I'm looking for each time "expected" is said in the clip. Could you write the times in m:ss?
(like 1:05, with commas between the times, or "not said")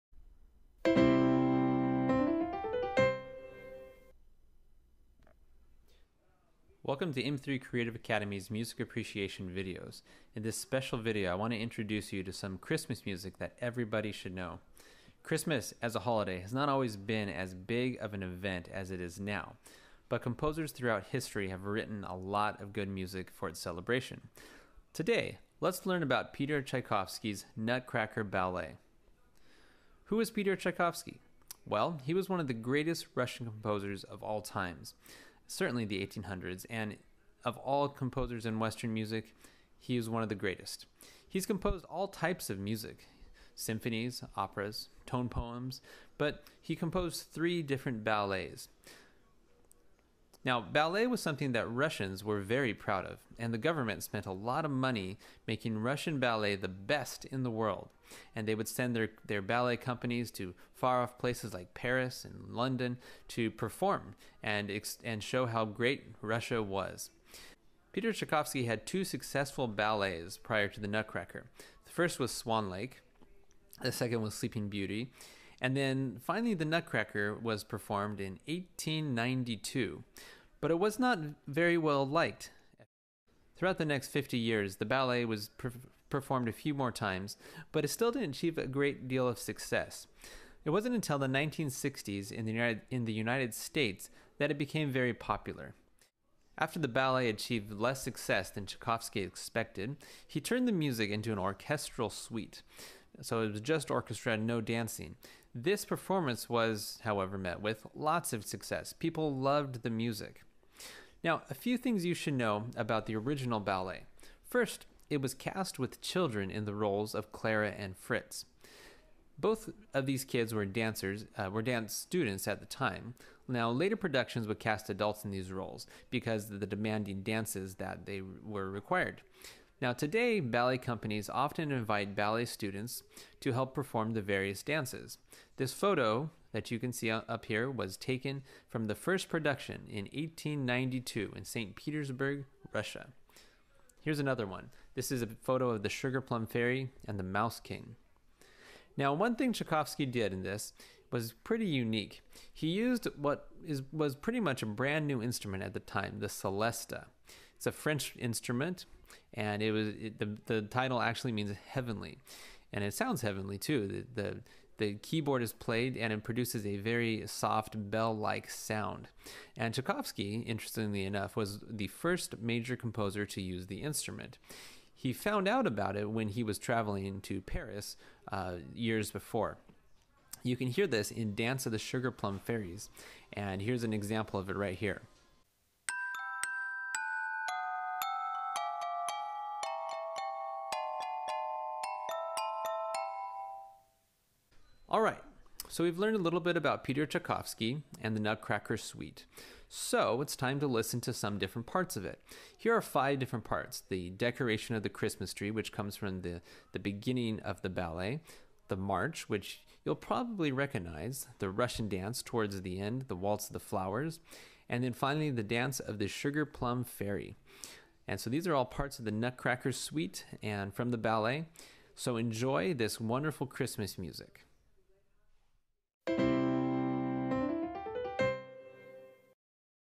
1:39.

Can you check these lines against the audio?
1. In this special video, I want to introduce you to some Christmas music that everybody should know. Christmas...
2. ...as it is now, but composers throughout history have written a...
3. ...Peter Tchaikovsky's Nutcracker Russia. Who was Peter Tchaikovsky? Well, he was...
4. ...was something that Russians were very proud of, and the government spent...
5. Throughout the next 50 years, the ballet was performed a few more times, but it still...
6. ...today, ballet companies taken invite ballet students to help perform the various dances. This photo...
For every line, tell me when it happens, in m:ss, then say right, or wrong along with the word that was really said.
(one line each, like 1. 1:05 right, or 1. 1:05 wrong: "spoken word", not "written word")
1. 0:10 right
2. 0:18 right
3. 0:26 wrong: "Ballet", not "Russia"
4. 0:51 right
5. 1:23 right
6. 2:09 wrong: "often", not "taken".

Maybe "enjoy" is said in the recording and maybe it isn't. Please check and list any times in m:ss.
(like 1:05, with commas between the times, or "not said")
3:42.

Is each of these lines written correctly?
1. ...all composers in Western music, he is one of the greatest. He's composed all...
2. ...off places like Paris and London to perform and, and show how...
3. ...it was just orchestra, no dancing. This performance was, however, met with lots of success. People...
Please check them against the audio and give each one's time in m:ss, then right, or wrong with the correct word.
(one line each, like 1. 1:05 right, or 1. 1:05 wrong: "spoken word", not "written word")
1. 0:37 right
2. 1:01 right
3. 1:43 right.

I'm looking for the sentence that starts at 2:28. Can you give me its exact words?
Now, one thing Tchaikovsky did in this was pretty unique.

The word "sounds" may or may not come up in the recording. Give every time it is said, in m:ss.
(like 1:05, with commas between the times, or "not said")
2:42, 2:48.